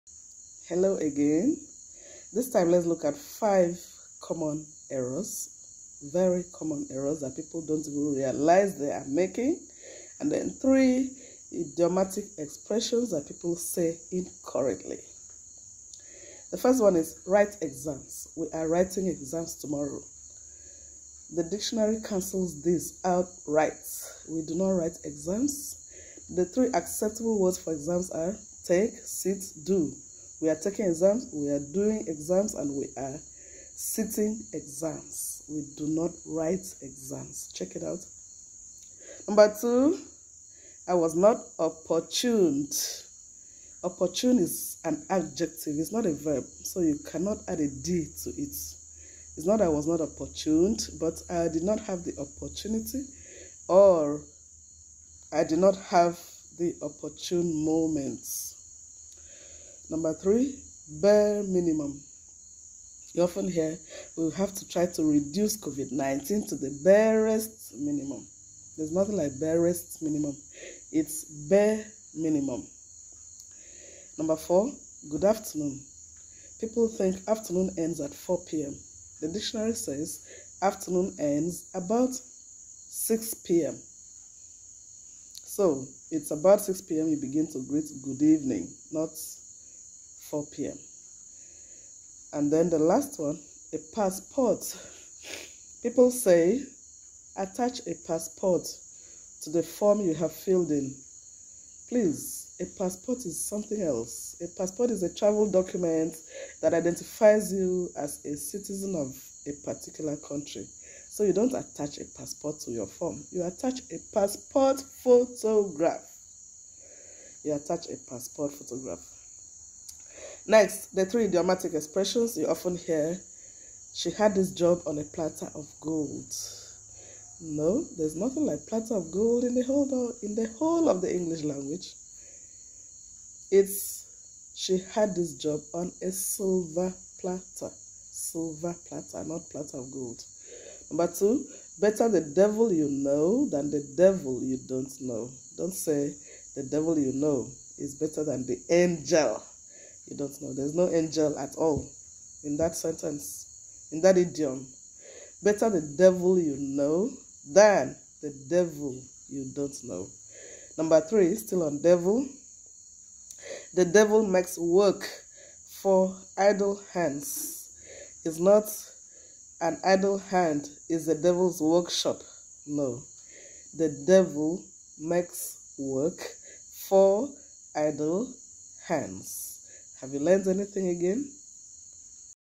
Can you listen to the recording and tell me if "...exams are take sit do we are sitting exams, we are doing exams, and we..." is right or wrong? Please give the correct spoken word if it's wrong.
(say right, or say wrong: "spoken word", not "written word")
wrong: "taking", not "sitting".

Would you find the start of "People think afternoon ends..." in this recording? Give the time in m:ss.
1:16.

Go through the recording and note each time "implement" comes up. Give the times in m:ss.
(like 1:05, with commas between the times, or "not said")
not said.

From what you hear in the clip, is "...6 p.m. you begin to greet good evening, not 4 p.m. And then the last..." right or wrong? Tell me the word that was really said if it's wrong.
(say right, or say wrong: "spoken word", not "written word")
right.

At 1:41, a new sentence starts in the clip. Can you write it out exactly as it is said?
Please, a passport is something else.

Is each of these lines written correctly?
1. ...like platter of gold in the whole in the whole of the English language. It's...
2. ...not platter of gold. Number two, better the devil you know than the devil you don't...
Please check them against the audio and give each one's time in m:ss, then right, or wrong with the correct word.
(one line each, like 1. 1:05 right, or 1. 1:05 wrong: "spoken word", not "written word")
1. 2:08 right
2. 2:19 right.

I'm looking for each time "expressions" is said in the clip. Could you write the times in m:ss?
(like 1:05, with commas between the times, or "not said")
0:12, 2:01.